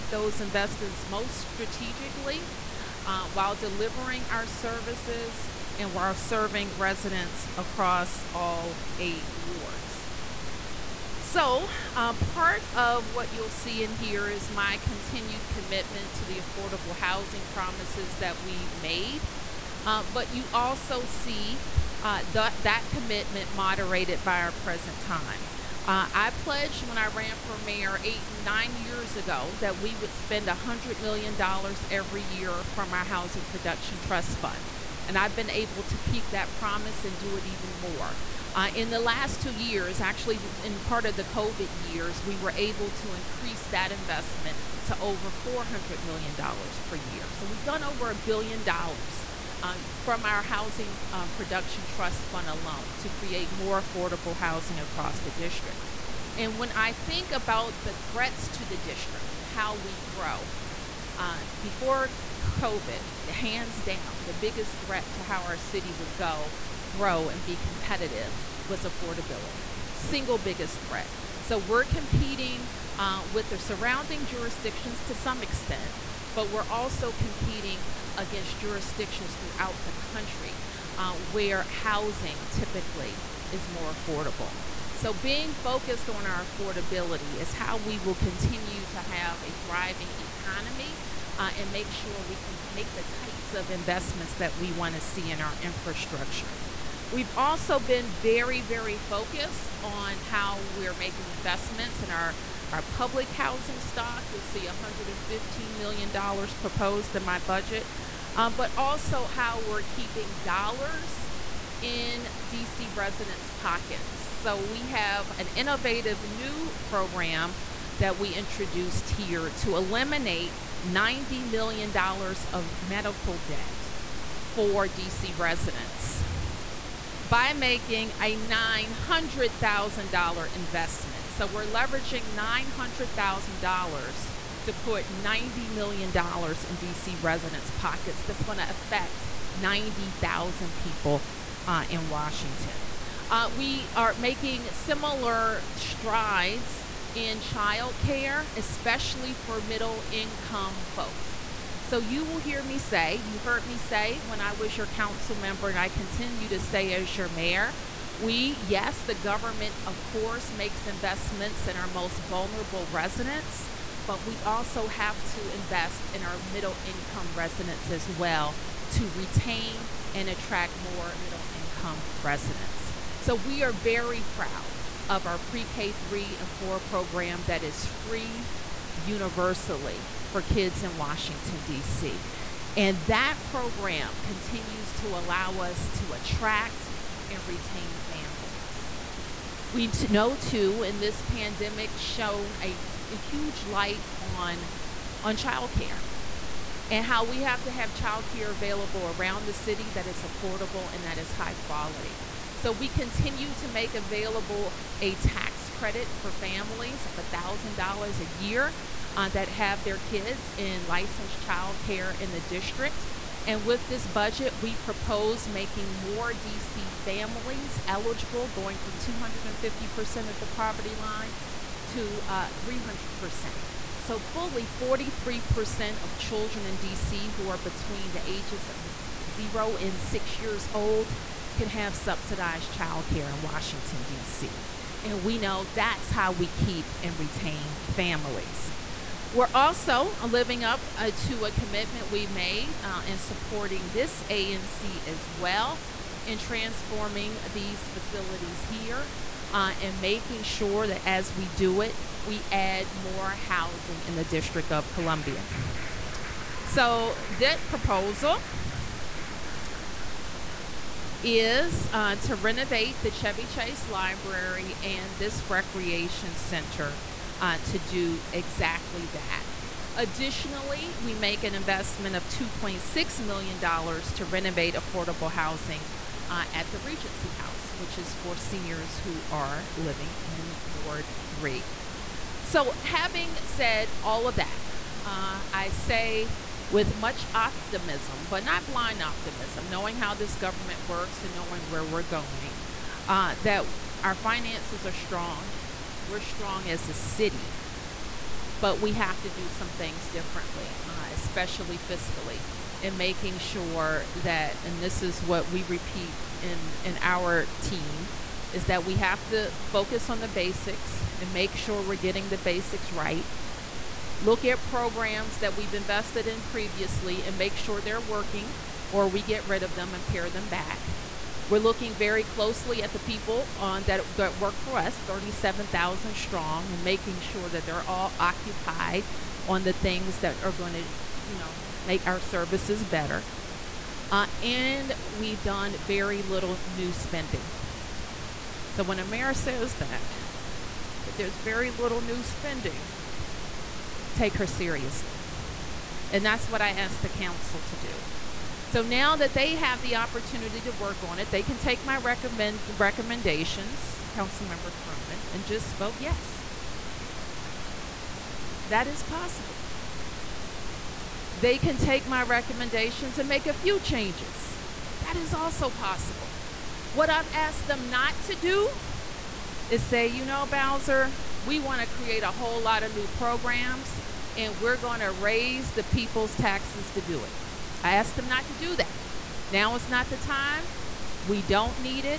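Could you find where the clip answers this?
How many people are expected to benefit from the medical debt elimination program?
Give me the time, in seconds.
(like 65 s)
139 s.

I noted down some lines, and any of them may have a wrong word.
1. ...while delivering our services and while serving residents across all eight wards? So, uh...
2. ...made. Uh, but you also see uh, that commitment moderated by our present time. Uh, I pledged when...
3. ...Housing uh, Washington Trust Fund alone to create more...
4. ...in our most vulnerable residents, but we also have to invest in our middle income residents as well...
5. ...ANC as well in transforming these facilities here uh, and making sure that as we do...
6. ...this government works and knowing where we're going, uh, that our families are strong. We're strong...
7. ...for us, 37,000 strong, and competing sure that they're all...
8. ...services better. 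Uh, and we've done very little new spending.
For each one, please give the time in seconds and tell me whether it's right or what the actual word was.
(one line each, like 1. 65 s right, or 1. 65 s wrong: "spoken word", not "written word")
1. 3 s right
2. 18 s right
3. 50 s wrong: "Production", not "Washington"
4. 161 s right
5. 244 s right
6. 290 s wrong: "finances", not "families"
7. 324 s wrong: "making", not "competing"
8. 332 s right.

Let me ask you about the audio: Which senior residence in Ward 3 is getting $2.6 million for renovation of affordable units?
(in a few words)
Regency House.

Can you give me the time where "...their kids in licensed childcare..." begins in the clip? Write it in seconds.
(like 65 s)
209 s.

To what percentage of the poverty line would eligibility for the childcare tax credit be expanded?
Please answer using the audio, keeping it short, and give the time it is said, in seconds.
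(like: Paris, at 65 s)
300%, at 222 s.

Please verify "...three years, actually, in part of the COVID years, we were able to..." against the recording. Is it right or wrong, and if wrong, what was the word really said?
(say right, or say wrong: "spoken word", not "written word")
wrong: "two", not "three".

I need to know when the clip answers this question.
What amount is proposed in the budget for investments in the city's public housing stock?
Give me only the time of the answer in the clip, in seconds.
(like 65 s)
104 s.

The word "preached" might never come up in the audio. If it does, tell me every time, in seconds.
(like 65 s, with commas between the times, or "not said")
not said.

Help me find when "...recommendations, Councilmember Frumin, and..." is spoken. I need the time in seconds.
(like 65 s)
352 s.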